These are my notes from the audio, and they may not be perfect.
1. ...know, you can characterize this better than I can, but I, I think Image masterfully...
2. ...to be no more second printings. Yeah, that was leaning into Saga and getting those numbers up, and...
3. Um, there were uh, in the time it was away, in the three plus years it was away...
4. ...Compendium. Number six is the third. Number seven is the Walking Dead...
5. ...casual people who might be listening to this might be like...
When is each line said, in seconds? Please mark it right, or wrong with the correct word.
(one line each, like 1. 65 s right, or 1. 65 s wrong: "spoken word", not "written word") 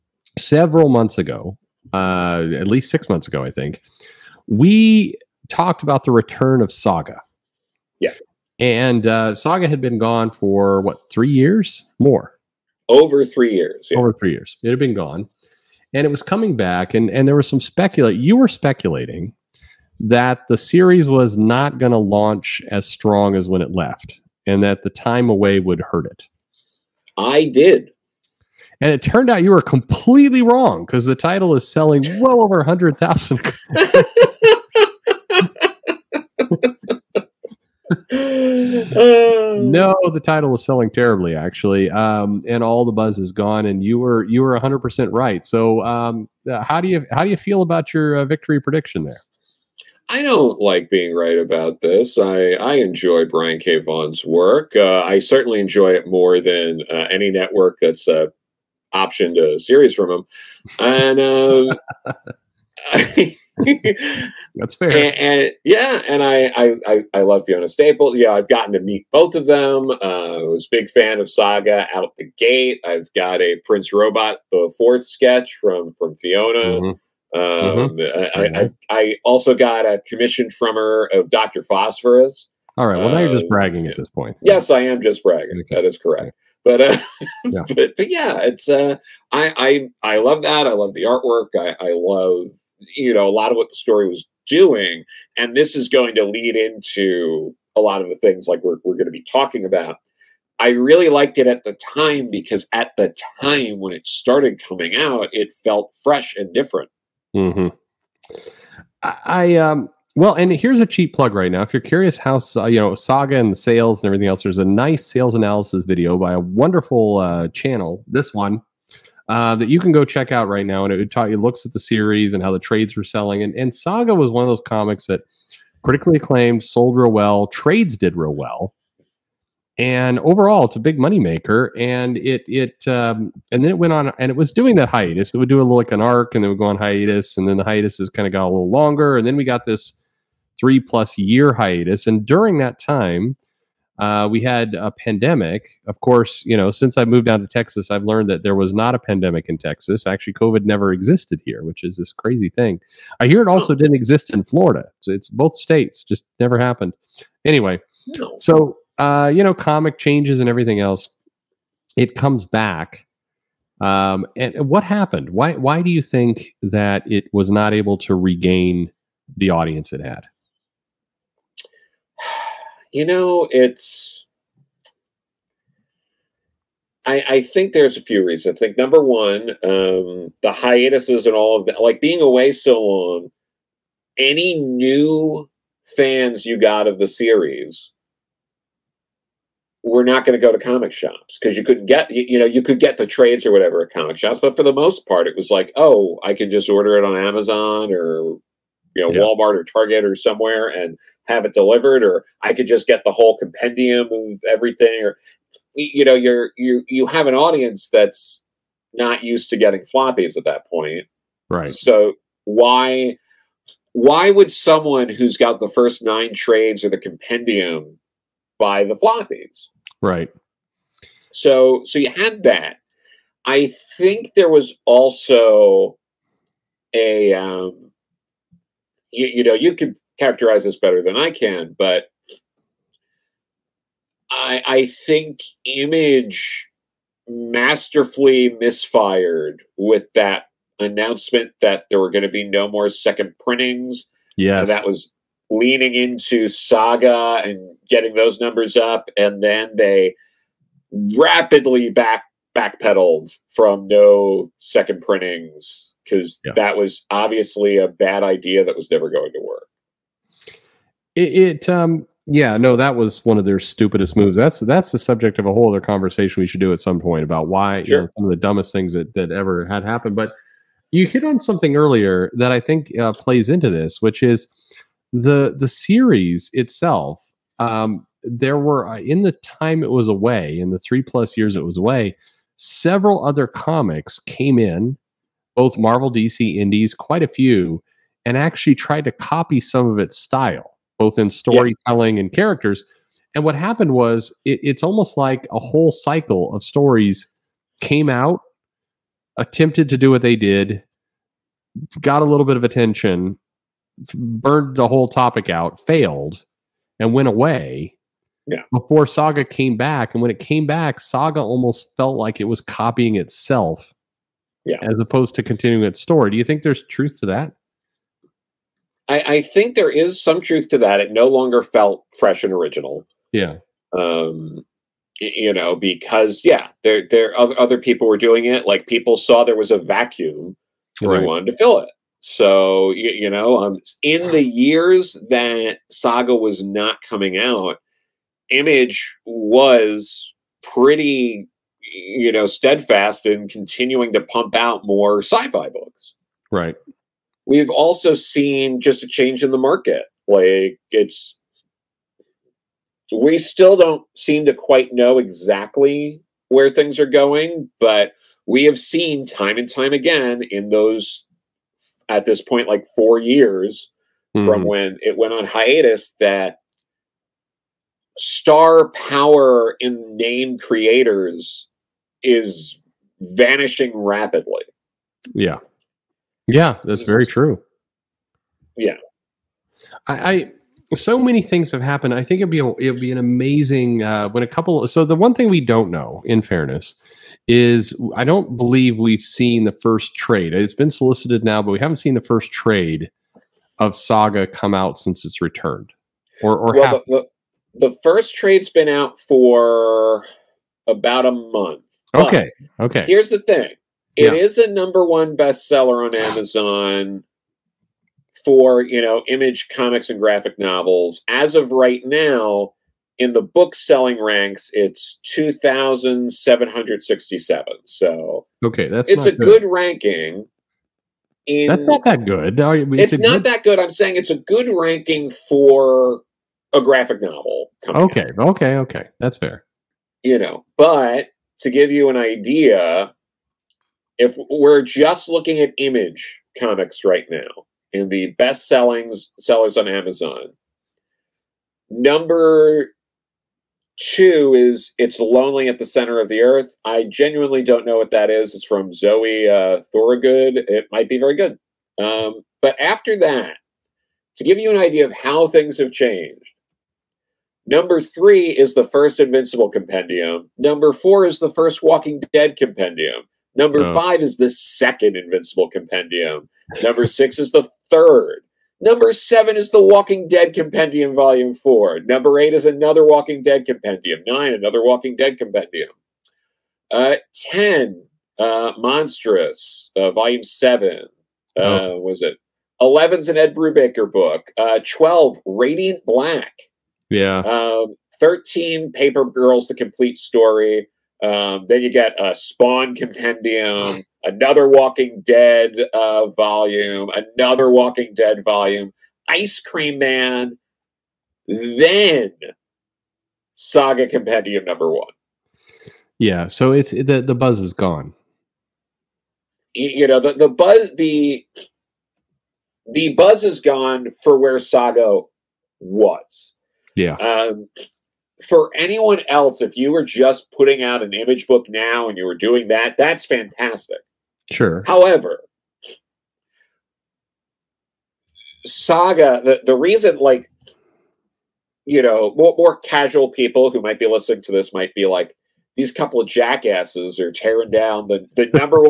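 1. 229 s right
2. 242 s right
3. 277 s right
4. 465 s right
5. 532 s right.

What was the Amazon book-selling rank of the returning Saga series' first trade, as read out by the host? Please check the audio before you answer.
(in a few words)
2,767.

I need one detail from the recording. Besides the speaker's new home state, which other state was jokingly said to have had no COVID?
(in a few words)
Florida.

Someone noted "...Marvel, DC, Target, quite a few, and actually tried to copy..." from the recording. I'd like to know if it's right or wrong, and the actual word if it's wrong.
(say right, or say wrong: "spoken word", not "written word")
wrong: "Indies", not "Target".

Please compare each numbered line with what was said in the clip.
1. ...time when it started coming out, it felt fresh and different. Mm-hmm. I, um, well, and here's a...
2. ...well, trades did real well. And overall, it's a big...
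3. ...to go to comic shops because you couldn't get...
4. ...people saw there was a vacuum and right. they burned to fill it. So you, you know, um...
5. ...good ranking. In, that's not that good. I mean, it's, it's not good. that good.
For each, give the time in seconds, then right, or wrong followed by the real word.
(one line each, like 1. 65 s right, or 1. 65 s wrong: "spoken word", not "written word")
1. 103 s right
2. 127 s right
3. 190 s right
4. 328 s wrong: "wanted", not "burned"
5. 419 s right.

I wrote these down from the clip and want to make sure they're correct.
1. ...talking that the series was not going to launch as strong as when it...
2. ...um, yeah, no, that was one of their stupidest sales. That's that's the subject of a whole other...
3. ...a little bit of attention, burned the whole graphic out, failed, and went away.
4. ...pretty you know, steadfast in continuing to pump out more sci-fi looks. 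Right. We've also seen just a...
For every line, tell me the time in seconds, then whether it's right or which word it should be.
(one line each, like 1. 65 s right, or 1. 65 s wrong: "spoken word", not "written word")
1. 18 s wrong: "speculating", not "talking"
2. 261 s wrong: "moves", not "sales"
3. 302 s wrong: "topic", not "graphic"
4. 340 s wrong: "books", not "looks".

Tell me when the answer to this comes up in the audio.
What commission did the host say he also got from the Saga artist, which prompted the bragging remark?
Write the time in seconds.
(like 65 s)
81 s.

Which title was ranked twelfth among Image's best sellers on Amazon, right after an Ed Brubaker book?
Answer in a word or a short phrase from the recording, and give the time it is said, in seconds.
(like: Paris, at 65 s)
Radiant Black, at 485 s.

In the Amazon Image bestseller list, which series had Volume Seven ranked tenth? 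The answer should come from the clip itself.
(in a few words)
Monstress.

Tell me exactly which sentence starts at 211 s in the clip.
So why why would someone who's got the first nine trades or the compendium buy the floppies?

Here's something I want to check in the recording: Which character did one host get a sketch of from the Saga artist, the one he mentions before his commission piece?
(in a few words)
Prince Robot the fourth.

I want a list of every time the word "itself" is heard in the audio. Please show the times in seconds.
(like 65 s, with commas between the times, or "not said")
276 s, 313 s.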